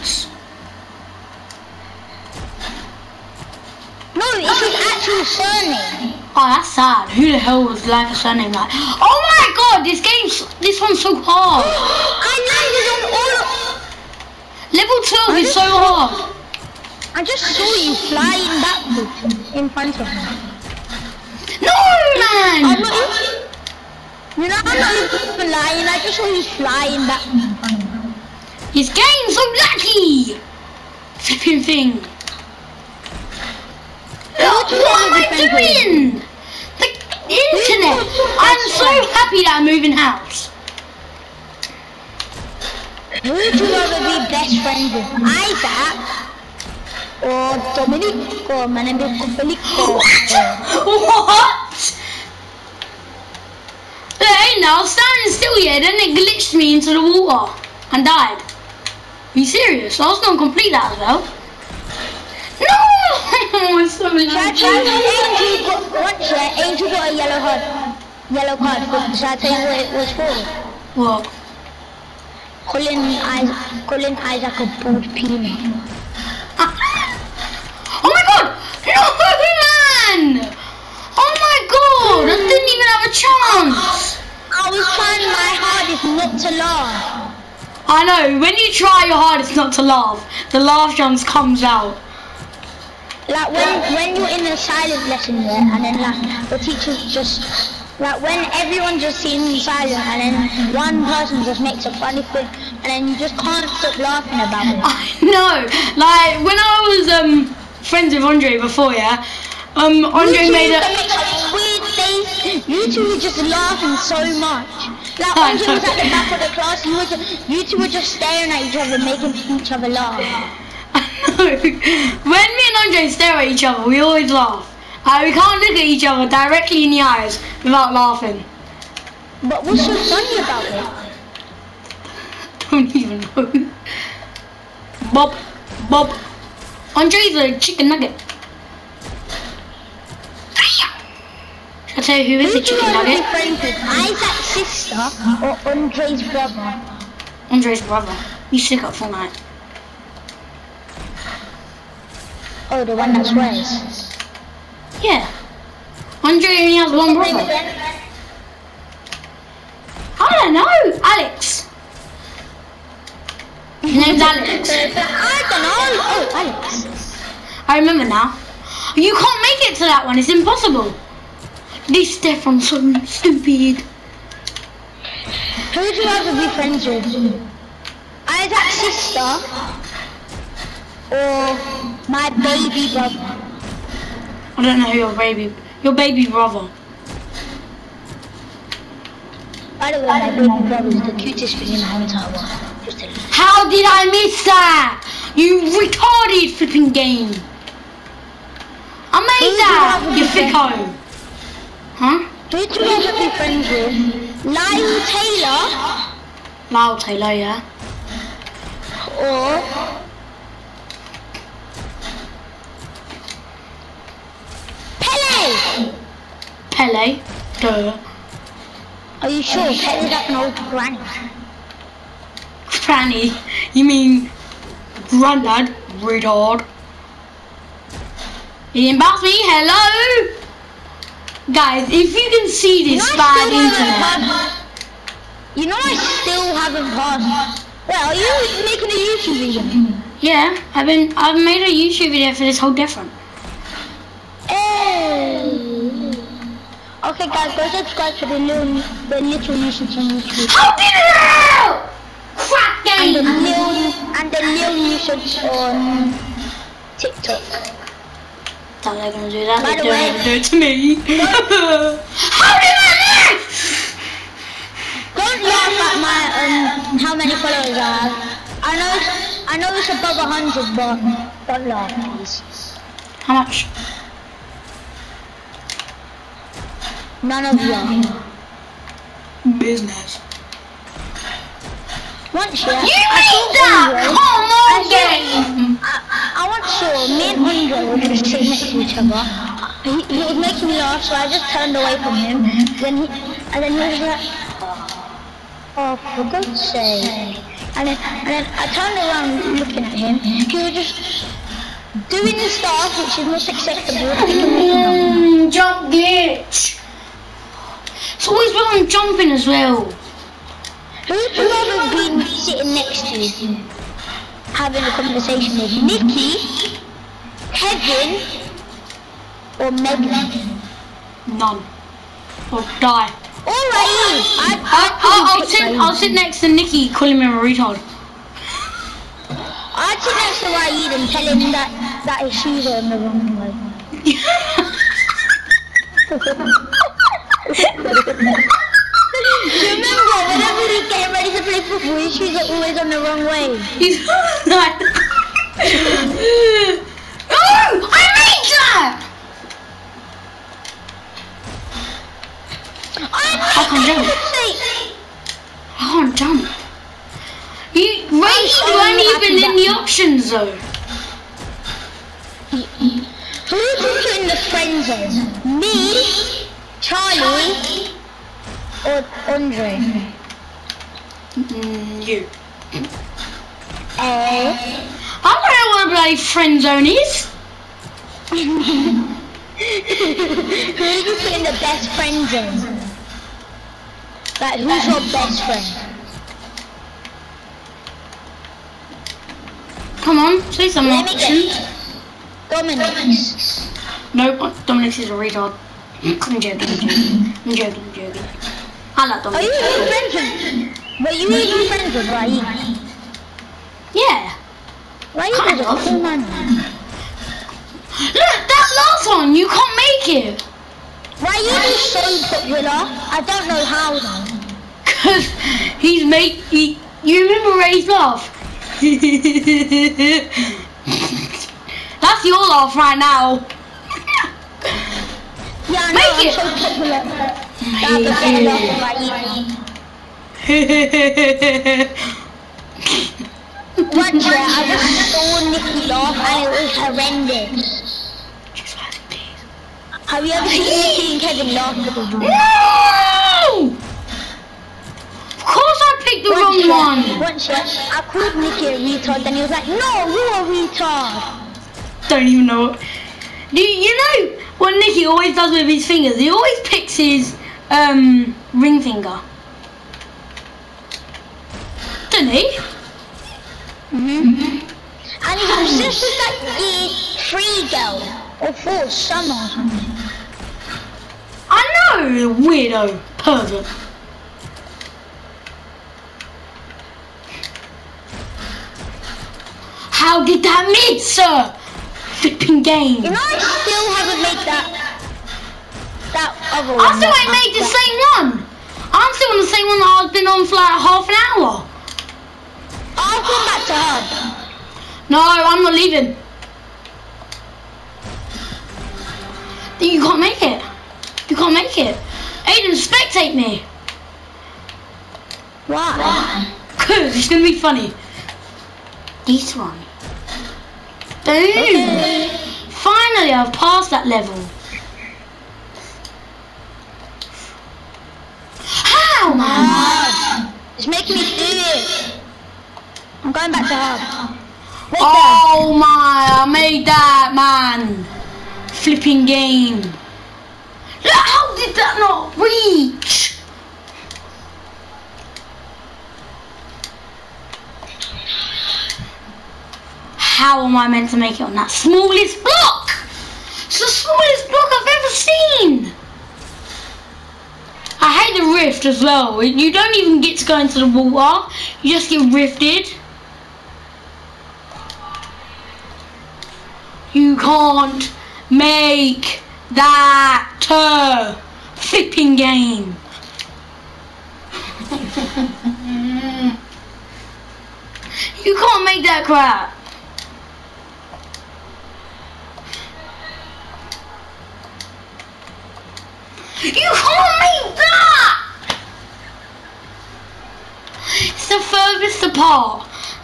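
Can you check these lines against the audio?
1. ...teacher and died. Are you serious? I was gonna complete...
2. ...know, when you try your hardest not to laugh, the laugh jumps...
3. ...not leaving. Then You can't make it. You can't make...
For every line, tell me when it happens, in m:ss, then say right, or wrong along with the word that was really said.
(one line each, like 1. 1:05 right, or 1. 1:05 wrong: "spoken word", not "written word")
1. 0:57 wrong: "water", not "teacher"
2. 1:28 right
3. 8:15 right.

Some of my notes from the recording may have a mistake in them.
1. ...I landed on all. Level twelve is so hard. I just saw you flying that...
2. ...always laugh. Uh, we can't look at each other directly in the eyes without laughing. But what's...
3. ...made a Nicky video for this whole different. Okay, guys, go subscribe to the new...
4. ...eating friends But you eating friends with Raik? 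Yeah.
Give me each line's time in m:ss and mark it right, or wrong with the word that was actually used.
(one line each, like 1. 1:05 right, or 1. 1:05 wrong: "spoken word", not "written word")
1. 0:12 right
2. 2:04 right
3. 4:01 wrong: "YouTube", not "Nicky"
4. 6:39 right.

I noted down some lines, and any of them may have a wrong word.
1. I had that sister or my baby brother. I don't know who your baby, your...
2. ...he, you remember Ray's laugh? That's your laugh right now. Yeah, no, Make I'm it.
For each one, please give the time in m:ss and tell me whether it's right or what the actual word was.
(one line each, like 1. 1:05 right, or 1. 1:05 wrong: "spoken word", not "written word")
1. 2:58 right
2. 6:56 right.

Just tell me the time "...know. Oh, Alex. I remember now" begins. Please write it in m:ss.
2:45.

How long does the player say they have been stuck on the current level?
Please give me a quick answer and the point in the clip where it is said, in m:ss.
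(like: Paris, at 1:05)
Half an hour, at 8:10.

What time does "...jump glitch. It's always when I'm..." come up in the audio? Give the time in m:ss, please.
5:05.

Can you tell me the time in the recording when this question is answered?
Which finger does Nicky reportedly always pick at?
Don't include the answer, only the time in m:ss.
7:38.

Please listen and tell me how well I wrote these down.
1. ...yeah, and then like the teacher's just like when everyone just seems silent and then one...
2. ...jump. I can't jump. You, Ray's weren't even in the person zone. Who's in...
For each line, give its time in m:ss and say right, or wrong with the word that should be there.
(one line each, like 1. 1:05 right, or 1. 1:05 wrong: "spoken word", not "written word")
1. 1:35 right
2. 5:53 wrong: "option", not "person".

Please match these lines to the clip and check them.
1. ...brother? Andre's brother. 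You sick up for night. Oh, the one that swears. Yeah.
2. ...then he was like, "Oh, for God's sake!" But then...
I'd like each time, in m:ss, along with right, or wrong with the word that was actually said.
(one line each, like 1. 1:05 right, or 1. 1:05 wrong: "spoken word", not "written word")
1. 2:26 right
2. 4:53 wrong: "And", not "But".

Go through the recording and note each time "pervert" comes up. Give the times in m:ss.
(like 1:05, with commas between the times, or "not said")
7:53.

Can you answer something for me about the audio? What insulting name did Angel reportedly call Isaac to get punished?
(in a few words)
Bald peanut.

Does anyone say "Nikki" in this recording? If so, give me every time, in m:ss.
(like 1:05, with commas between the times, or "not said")
5:15, 5:26, 7:20.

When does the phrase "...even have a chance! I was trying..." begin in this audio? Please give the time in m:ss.
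1:22.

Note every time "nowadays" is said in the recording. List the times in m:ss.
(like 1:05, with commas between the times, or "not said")
not said.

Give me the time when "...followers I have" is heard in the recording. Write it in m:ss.
4:27.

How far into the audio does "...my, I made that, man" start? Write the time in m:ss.
8:45.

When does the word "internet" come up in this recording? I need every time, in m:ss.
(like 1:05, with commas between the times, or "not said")
0:37, 3:53.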